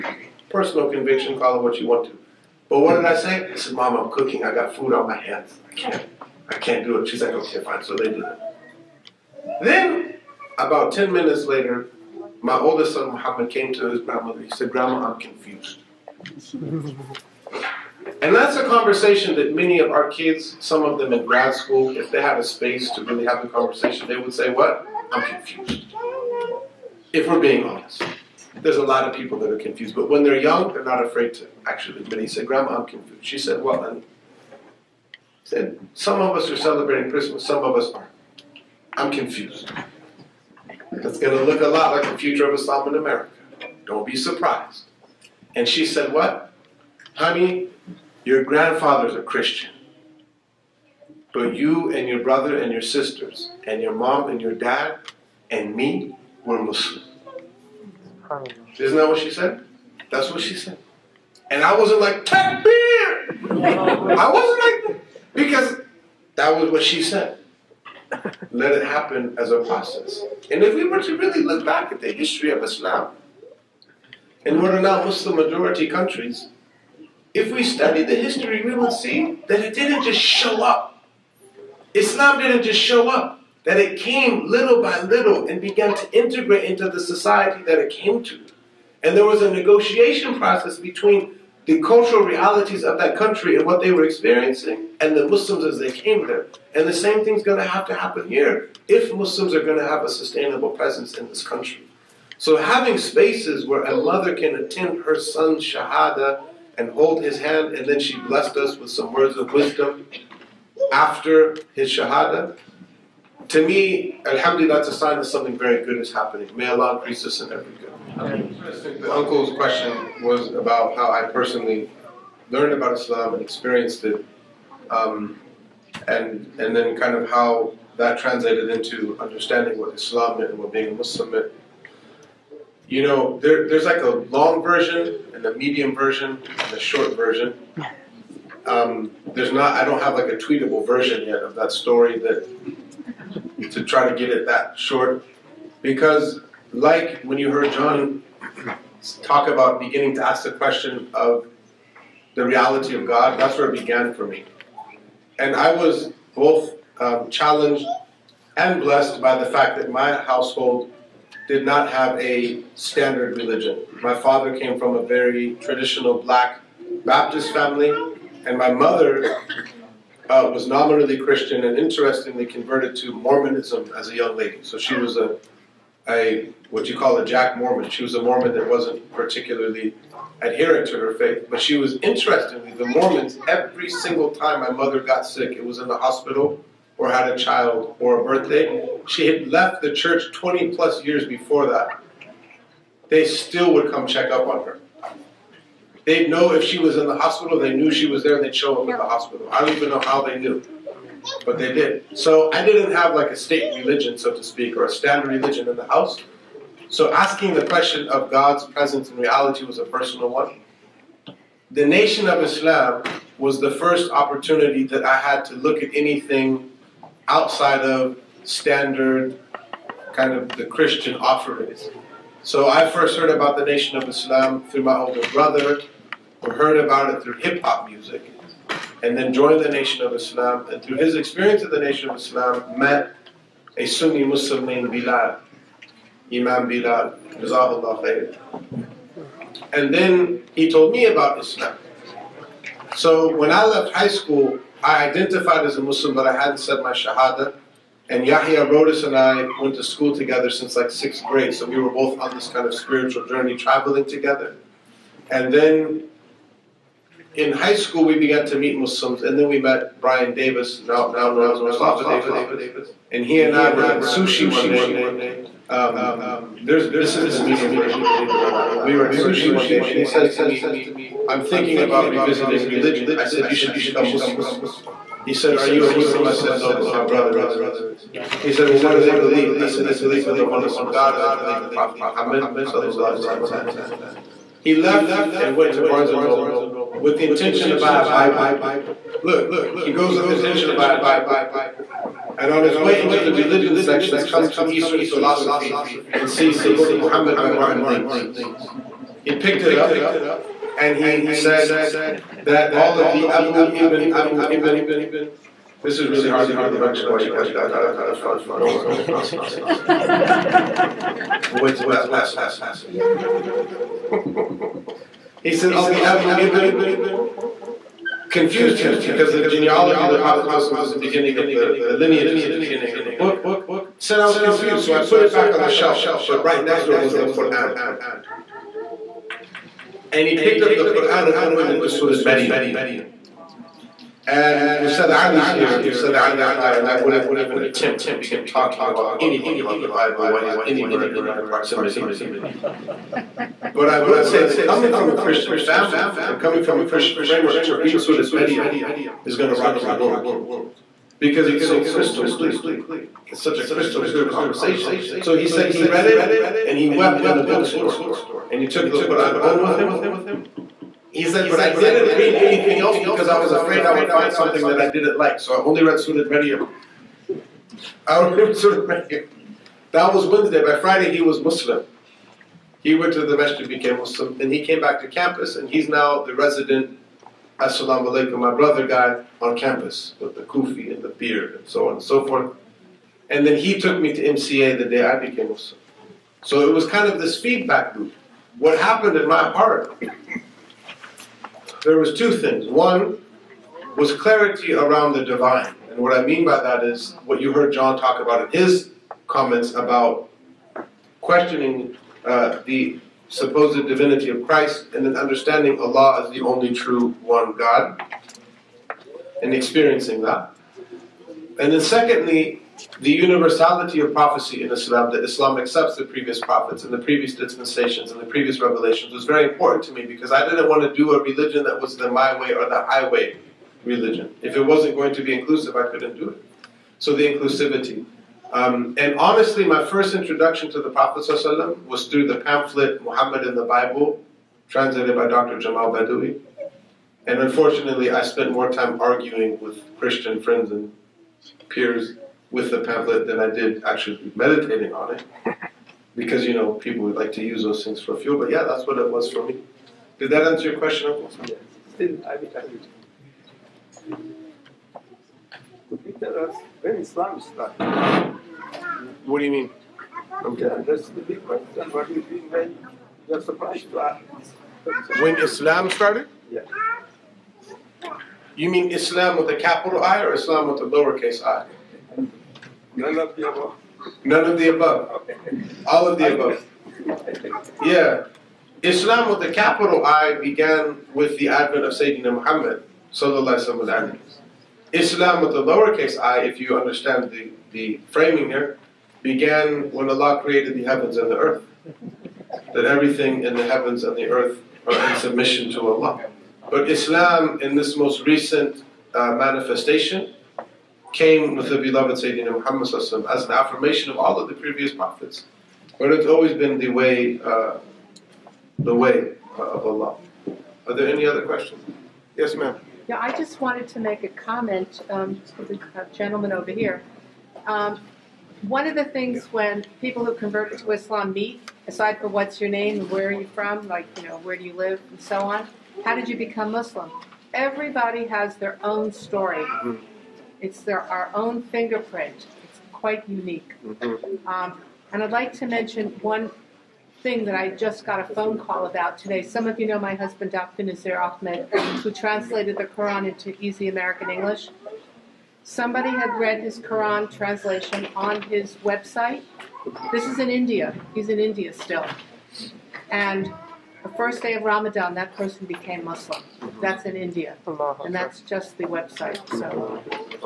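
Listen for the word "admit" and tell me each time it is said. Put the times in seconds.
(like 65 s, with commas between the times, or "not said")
32 s.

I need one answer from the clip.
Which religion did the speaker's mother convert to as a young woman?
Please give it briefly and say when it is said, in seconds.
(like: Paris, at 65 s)
Mormonism, at 173 s.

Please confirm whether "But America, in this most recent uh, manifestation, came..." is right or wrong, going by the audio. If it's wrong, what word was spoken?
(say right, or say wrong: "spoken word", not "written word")
wrong: "Islam", not "America".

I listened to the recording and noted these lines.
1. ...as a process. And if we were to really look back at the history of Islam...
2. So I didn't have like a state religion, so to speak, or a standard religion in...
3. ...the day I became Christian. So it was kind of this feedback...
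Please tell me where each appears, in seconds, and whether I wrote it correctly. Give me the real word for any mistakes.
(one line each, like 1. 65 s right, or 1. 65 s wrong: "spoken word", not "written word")
1. 69 s right
2. 202 s right
3. 384 s wrong: "Muslim", not "Christian".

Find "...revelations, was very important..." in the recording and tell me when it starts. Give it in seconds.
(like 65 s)
418 s.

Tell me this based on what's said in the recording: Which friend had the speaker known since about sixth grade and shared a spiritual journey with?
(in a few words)
Yahya Rhodus.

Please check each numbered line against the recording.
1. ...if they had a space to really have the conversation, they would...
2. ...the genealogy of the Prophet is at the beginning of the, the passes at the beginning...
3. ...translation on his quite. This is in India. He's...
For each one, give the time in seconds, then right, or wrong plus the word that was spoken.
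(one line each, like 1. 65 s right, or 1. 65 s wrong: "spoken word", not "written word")
1. 21 s right
2. 319 s wrong: "lineages", not "passes"
3. 547 s wrong: "website", not "quite".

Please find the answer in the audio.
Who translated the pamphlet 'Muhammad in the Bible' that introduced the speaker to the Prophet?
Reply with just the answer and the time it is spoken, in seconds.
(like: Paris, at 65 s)
Dr. Jamal Badawi, at 435 s.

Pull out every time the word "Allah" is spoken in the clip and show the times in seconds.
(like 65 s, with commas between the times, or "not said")
116 s, 405 s, 490 s, 495 s, 509 s.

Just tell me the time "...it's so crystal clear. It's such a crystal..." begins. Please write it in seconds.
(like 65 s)
351 s.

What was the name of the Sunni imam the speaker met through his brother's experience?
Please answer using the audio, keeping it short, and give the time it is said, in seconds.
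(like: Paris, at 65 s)
Imam Bilal, at 236 s.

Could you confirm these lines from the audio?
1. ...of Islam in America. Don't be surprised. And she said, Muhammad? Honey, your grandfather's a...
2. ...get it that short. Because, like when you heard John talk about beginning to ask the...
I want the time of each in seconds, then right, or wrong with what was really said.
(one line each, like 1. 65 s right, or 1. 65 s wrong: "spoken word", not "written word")
1. 42 s wrong: "What", not "Muhammad"
2. 144 s right.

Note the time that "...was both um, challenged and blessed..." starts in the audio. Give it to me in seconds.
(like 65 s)
155 s.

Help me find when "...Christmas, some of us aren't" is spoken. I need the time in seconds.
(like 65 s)
37 s.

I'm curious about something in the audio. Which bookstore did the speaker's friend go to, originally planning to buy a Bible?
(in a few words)
Barnes and Noble.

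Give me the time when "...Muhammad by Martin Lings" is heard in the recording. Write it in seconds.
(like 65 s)
296 s.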